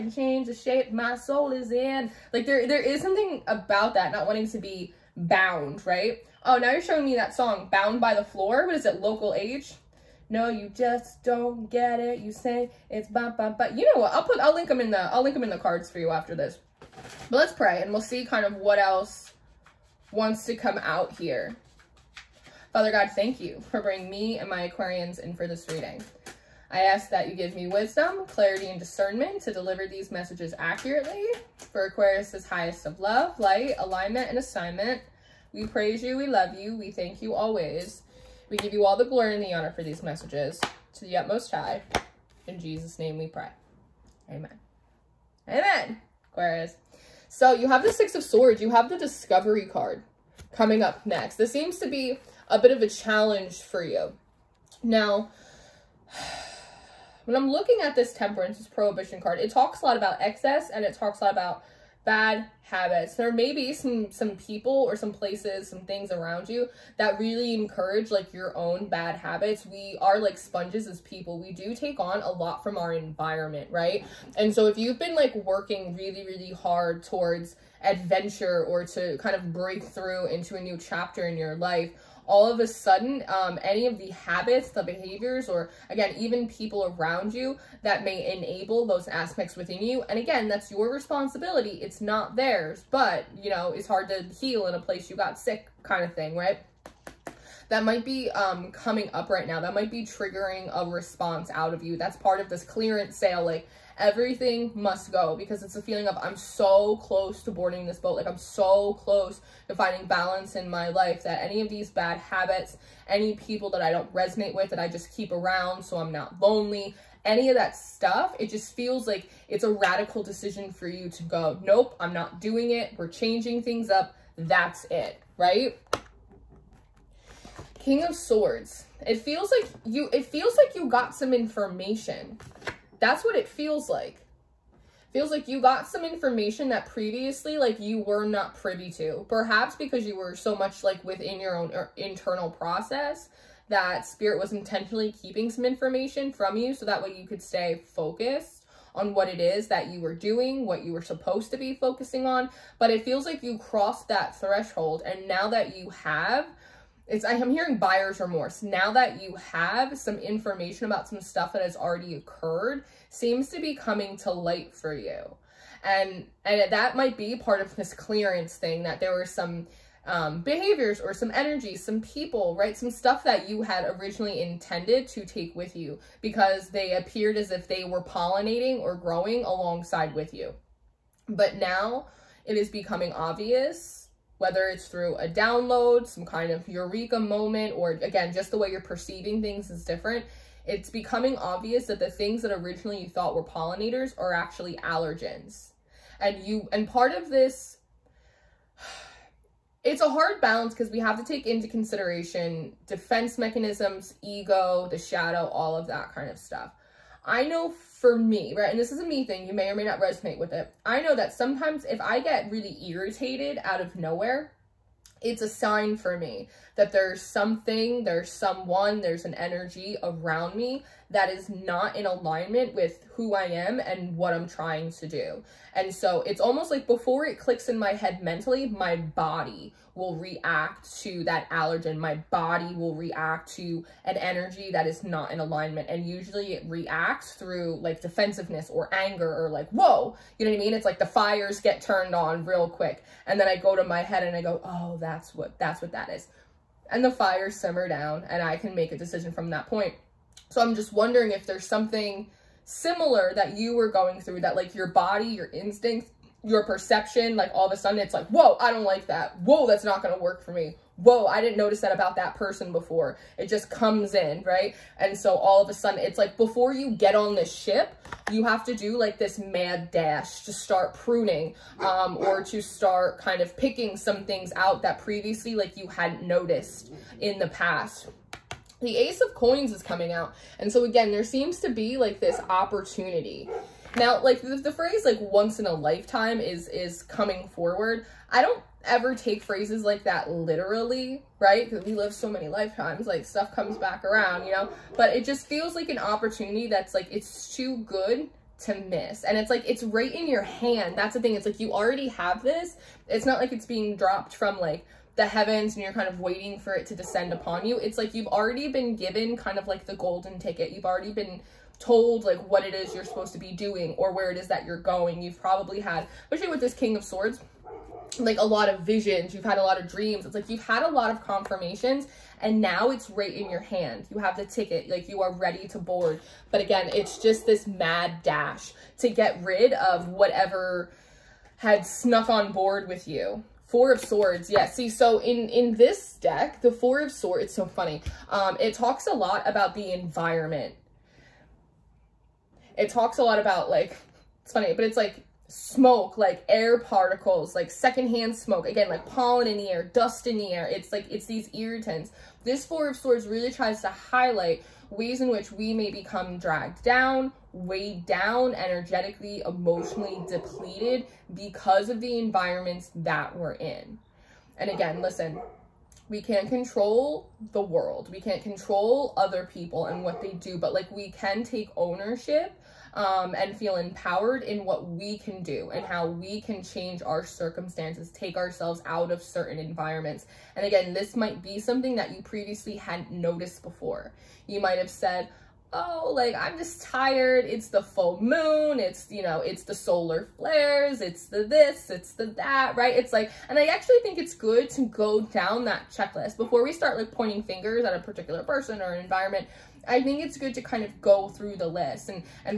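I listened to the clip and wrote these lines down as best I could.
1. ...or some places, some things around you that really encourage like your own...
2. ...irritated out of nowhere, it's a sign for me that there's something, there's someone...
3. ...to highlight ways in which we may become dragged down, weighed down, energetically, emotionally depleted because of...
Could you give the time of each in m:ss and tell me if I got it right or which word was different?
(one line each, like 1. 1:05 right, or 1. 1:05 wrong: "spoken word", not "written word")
1. 1:04 right
2. 3:32 right
3. 5:53 right.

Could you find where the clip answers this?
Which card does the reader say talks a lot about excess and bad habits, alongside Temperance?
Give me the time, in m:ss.
0:58.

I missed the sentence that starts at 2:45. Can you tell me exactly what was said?
And and that might be part of this clearance thing that there were some um, behaviors or some energy, some people, right?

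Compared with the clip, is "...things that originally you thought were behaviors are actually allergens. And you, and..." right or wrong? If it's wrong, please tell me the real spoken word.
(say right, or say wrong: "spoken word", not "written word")
wrong: "pollinators", not "behaviors".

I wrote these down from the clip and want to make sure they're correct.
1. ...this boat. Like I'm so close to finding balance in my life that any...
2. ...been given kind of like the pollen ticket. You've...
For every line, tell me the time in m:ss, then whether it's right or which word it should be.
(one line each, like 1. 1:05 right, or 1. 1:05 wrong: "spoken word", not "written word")
1. 1:47 right
2. 5:08 wrong: "golden", not "pollen".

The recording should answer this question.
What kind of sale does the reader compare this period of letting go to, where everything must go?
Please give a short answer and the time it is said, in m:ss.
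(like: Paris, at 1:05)
Clearance sale, at 1:42.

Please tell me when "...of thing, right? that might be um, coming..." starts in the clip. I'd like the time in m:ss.
1:36.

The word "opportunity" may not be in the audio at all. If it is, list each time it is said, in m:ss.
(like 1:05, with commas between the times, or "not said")
4:42, 4:55.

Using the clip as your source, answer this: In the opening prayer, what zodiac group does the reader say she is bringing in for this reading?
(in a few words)
Aquarians.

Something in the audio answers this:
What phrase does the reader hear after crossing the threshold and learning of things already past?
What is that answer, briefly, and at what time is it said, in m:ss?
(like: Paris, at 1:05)
Buyer's remorse, at 2:37.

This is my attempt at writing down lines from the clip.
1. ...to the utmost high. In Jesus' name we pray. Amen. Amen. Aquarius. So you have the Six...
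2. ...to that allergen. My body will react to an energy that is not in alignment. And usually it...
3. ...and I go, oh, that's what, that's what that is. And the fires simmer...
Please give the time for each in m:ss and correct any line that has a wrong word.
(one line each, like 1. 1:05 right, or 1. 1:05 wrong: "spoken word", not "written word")
1. 0:40 right
2. 3:51 right
3. 4:04 right.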